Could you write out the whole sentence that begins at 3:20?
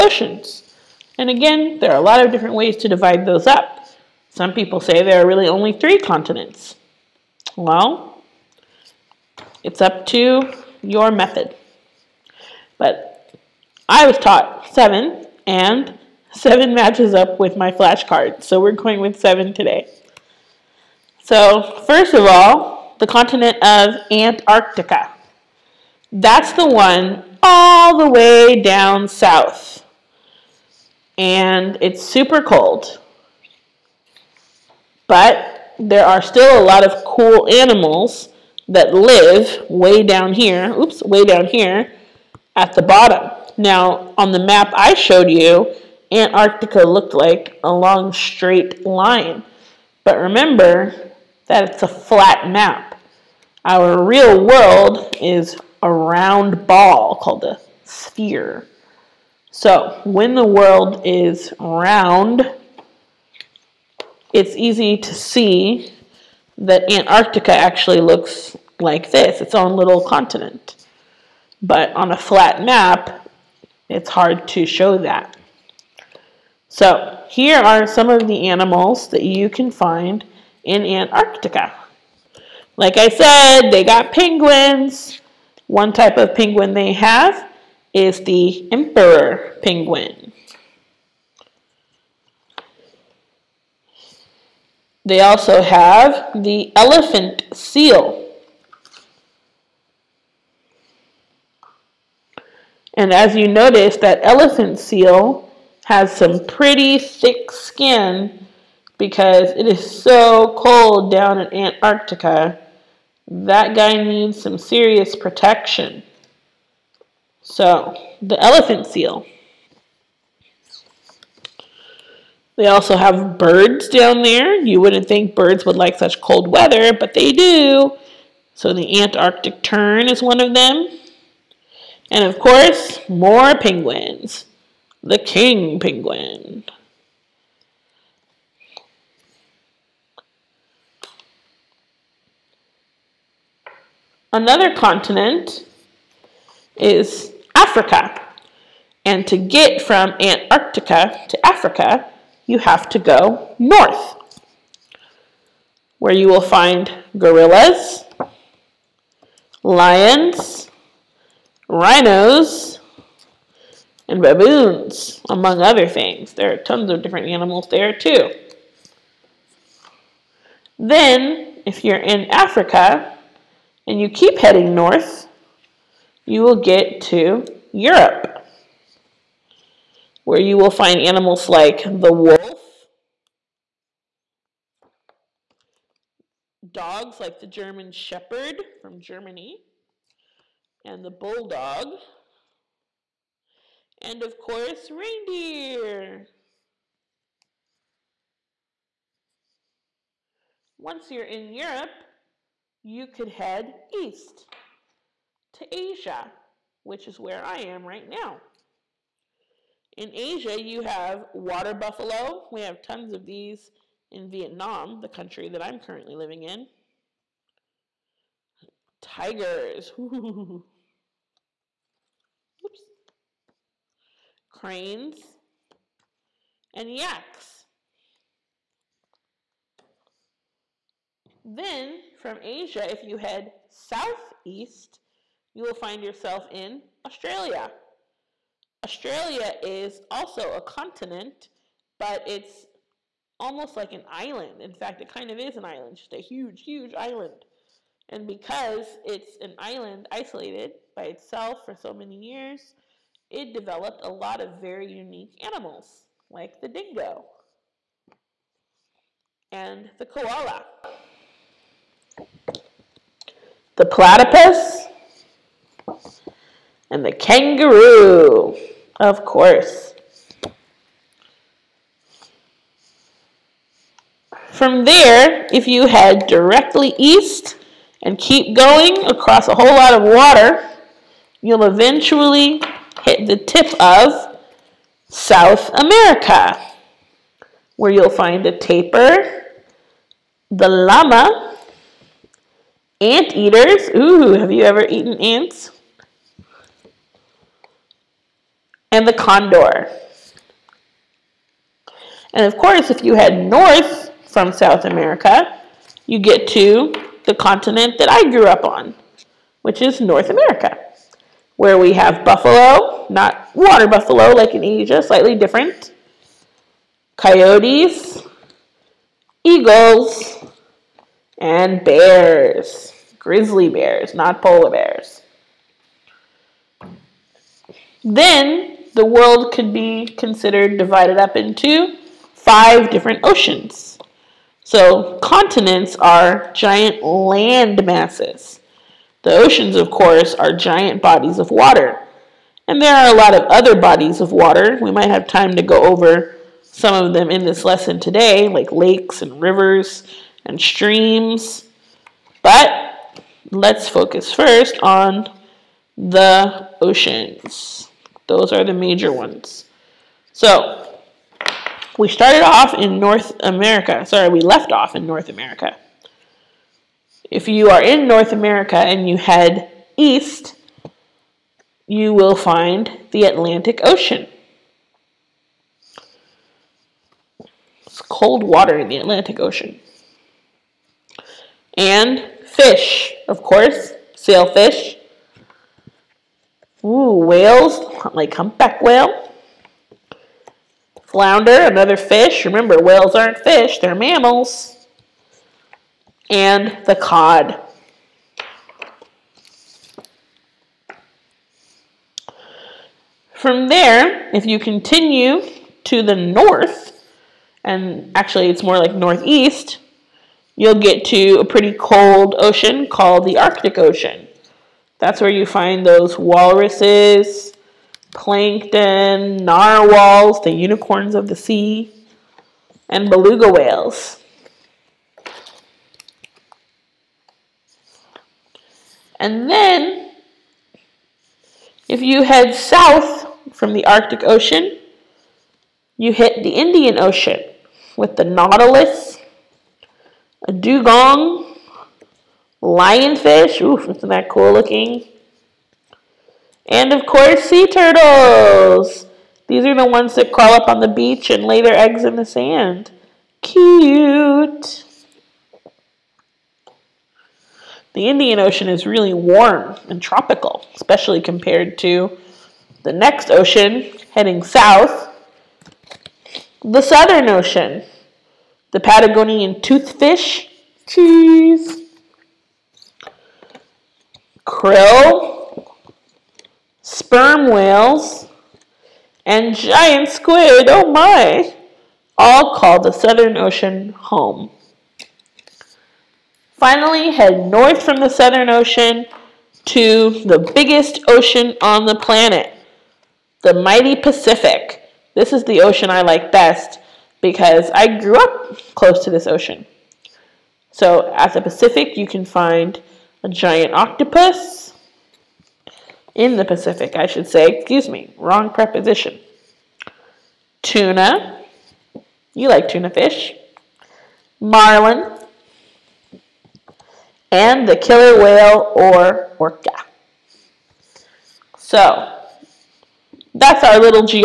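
Once you're in Europe, you could head east to Asia, which is where I am right now.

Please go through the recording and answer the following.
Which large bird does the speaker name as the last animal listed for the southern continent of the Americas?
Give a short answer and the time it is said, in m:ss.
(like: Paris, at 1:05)
condor, at 4:59.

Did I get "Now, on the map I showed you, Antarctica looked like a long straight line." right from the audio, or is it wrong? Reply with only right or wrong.
right.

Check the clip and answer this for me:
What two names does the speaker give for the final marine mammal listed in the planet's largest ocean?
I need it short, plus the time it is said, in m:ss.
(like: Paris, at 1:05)
killer whale or orca, at 8:37.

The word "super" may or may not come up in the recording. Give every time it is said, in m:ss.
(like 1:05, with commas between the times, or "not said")
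0:32.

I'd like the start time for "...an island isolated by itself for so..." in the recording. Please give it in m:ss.
4:09.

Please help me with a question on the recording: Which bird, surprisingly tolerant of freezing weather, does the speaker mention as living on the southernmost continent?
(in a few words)
Antarctic tern.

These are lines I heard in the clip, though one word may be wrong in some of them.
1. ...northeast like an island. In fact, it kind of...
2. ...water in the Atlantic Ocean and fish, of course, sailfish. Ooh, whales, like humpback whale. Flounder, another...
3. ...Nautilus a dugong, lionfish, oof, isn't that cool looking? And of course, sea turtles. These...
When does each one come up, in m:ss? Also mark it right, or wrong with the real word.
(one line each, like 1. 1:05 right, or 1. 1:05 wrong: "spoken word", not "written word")
1. 4:03 wrong: "almost", not "northeast"
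2. 6:18 right
3. 7:18 right.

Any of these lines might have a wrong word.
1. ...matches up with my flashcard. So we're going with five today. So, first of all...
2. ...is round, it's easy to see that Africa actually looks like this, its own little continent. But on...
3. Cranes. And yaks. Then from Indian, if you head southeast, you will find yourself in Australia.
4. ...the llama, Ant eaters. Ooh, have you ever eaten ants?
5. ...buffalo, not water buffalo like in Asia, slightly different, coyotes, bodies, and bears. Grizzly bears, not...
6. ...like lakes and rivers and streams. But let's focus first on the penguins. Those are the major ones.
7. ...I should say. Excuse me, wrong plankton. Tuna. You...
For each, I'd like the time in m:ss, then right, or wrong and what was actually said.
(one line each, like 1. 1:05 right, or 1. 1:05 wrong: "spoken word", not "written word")
1. 0:16 wrong: "seven", not "five"
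2. 1:01 wrong: "Antarctica", not "Africa"
3. 3:44 wrong: "Asia", not "Indian"
4. 4:50 right
5. 5:12 wrong: "eagles", not "bodies"
6. 5:48 wrong: "oceans", not "penguins"
7. 8:26 wrong: "preposition", not "plankton".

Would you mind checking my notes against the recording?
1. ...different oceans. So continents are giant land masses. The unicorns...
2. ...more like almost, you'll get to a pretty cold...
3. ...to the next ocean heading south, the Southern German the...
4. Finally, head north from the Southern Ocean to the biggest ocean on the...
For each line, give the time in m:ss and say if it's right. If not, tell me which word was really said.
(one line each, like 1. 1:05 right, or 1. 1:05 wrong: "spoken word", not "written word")
1. 5:32 wrong: "oceans", not "unicorns"
2. 6:48 wrong: "northeast", not "almost"
3. 7:41 wrong: "Ocean", not "German"
4. 8:06 right.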